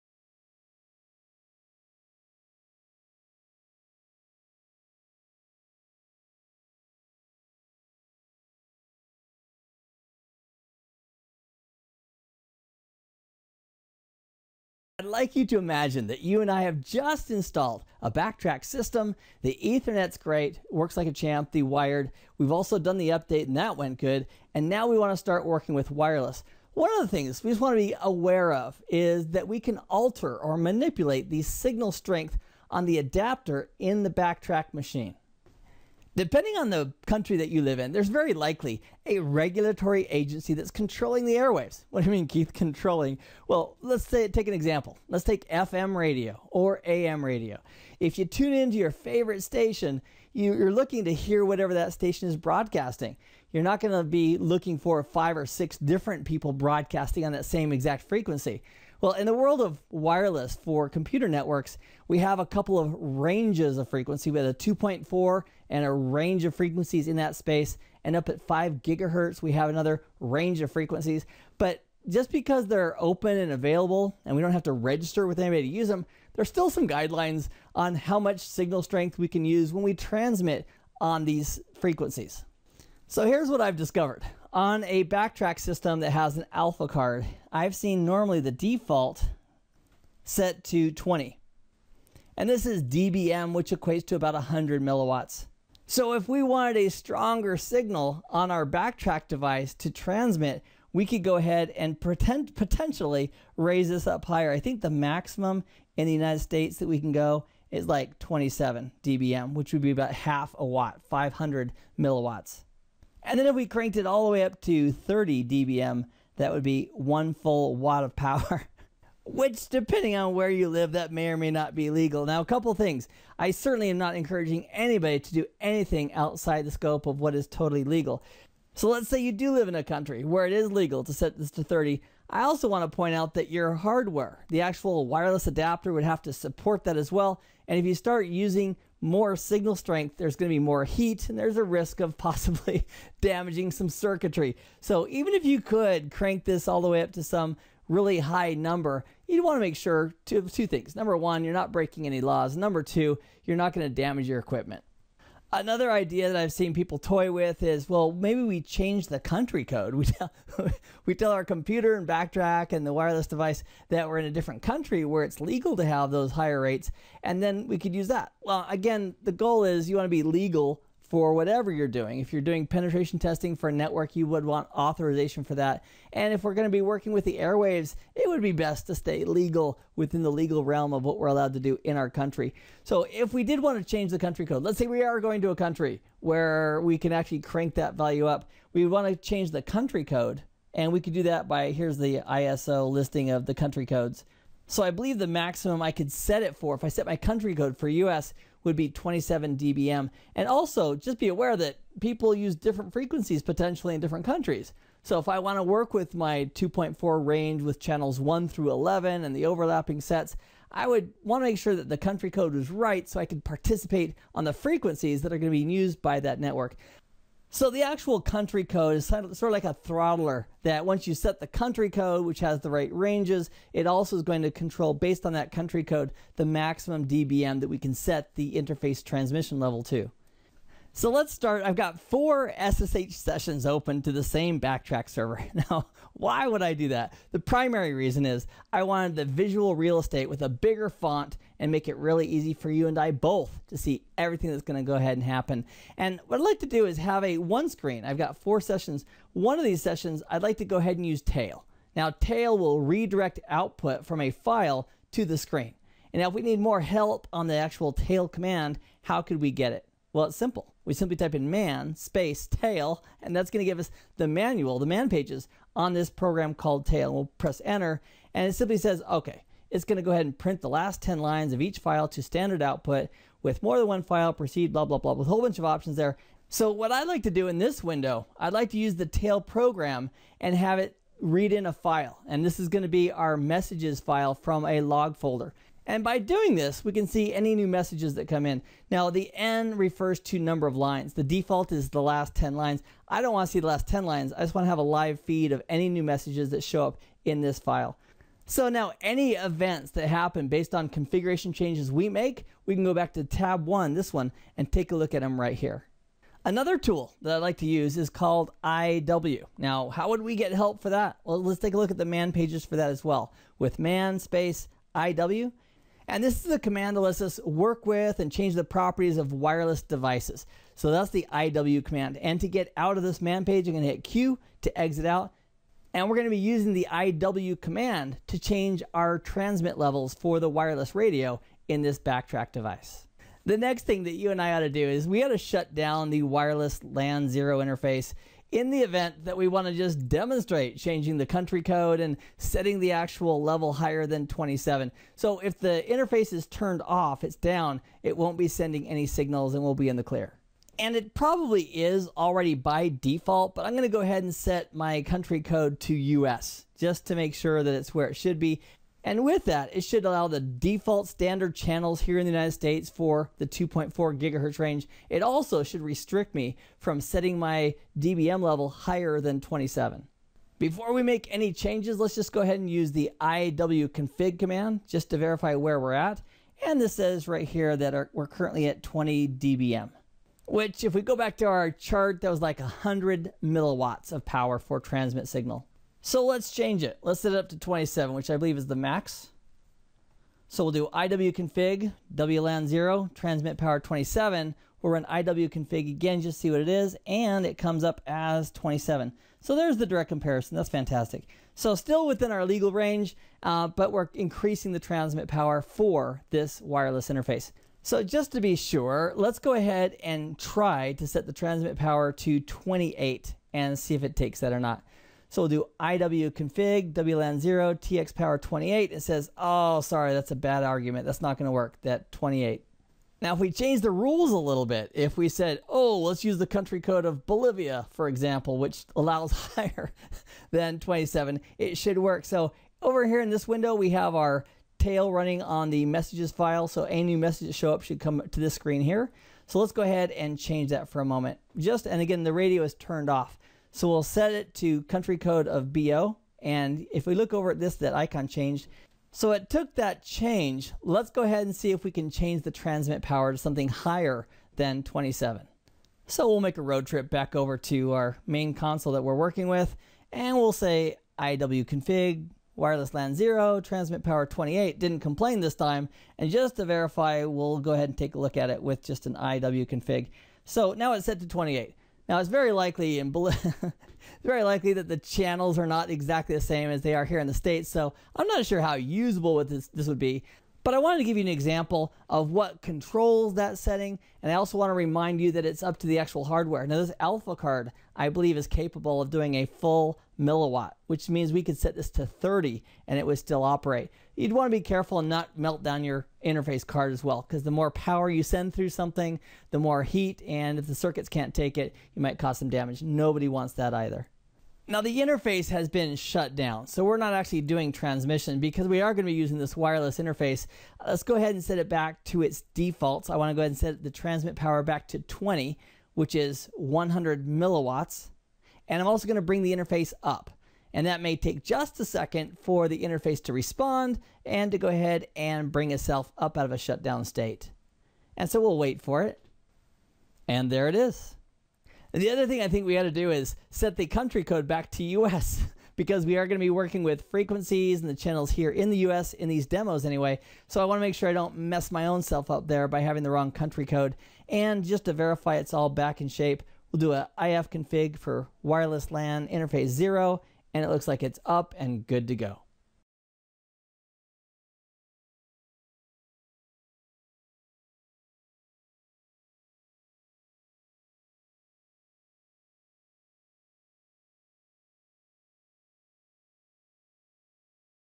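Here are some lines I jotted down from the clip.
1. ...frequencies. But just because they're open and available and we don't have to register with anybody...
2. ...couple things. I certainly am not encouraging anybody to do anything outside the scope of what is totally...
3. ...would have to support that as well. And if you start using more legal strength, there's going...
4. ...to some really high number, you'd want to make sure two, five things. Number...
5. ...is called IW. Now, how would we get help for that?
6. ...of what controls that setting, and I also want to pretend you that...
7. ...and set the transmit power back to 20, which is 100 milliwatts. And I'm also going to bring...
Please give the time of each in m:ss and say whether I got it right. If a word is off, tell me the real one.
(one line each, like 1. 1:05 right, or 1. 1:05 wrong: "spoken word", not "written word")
1. 1:10 right
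2. 2:02 right
3. 2:15 wrong: "signal", not "legal"
4. 2:27 wrong: "two", not "five"
5. 5:07 right
6. 8:02 wrong: "remind", not "pretend"
7. 8:33 right.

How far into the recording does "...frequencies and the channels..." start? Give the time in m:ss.
8:57.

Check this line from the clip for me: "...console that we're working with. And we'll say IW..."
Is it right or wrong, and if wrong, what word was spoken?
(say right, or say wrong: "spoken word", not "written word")
right.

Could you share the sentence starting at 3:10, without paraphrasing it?
And we could do that by here's the ISO listing of the country codes.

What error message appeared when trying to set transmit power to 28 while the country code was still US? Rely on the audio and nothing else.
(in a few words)
bad argument.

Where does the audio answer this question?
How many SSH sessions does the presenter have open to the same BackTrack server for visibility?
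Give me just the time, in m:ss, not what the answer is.
3:52.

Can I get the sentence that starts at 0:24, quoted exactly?
And now we want to start working with wireless.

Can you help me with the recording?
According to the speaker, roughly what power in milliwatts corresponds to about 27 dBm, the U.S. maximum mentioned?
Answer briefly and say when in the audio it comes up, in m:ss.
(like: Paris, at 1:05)
500 milliwatts, at 1:51.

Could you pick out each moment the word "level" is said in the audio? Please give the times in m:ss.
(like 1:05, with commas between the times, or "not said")
3:49, 5:29, 5:43, 6:08.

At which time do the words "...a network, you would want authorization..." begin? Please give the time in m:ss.
2:53.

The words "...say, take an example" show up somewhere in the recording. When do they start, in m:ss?
0:44.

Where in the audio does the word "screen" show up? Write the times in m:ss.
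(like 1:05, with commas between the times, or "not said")
4:07, 4:15, 7:18.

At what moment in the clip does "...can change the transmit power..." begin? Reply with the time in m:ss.
7:31.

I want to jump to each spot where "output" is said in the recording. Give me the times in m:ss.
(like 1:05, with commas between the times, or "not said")
4:13, 4:32.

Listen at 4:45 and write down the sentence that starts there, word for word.
And by doing this, we can see any new messages that come in.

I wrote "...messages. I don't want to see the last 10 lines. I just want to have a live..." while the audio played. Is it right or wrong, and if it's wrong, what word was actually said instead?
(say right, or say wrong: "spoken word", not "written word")
wrong: "lines", not "messages".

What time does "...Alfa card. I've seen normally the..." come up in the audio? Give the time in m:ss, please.
1:26.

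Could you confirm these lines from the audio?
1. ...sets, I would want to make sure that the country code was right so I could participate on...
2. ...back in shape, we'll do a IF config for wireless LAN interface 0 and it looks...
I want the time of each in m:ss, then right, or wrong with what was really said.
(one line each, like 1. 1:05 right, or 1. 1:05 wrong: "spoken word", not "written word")
1. 3:29 right
2. 9:05 right.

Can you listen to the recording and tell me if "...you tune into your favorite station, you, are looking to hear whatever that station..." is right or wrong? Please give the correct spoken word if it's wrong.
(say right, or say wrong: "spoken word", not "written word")
right.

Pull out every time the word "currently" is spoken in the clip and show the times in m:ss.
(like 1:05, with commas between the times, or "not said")
6:18.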